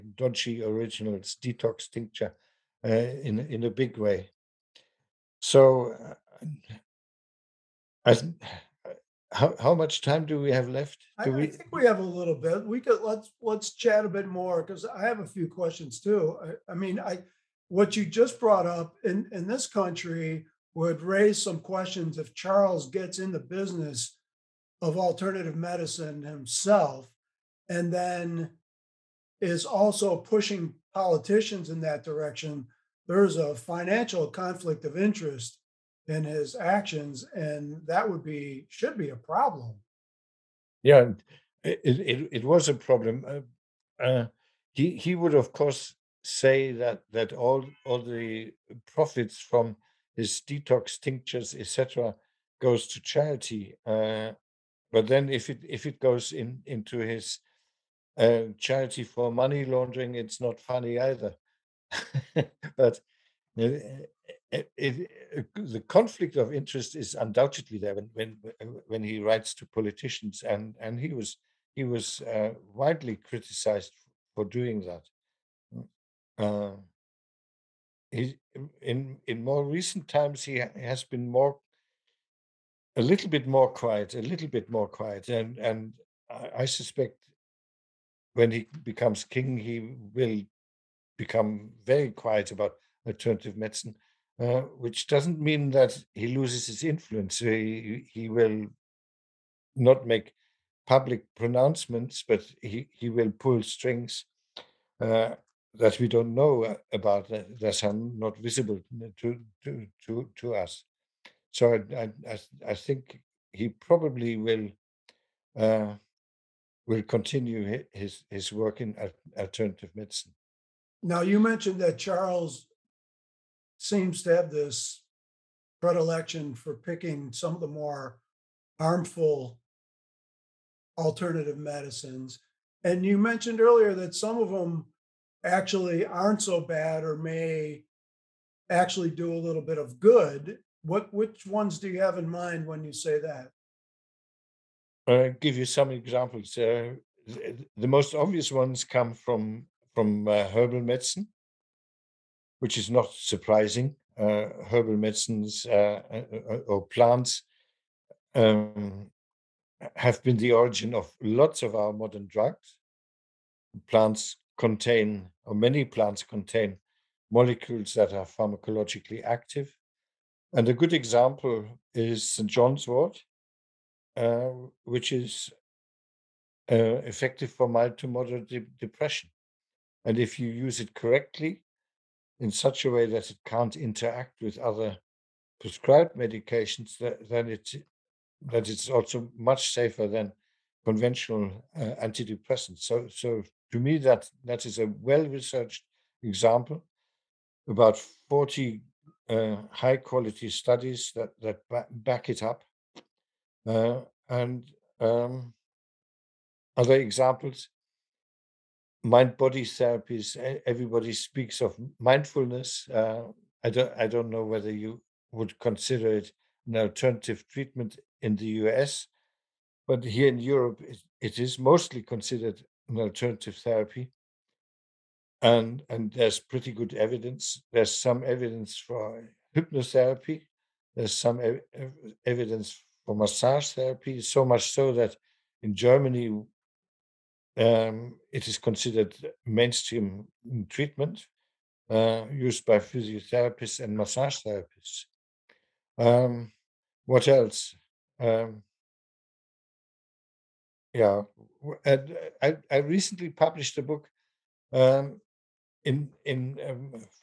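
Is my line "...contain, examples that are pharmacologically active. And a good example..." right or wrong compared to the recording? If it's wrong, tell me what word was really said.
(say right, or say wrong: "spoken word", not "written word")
wrong: "molecules", not "examples".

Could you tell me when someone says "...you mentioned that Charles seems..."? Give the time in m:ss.
2:01.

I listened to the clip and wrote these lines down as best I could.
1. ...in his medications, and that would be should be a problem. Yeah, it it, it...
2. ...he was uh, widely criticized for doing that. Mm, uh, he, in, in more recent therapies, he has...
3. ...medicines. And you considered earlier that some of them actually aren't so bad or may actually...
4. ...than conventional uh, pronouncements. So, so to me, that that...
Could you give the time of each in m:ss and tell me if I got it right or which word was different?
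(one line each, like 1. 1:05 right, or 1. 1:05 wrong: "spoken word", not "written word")
1. 0:36 wrong: "actions", not "medications"
2. 1:11 wrong: "times", not "therapies"
3. 2:11 wrong: "mentioned", not "considered"
4. 3:10 wrong: "antidepressants", not "pronouncements".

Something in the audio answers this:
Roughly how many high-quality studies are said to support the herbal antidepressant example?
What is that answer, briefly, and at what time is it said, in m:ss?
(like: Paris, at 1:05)
40, at 3:18.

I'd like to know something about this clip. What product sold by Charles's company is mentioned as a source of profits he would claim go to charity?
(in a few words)
detox tinctures.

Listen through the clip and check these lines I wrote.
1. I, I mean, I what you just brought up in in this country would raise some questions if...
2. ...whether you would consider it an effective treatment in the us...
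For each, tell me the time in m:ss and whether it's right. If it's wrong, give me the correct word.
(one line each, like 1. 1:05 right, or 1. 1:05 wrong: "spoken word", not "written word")
1. 0:16 right
2. 3:34 wrong: "alternative", not "effective".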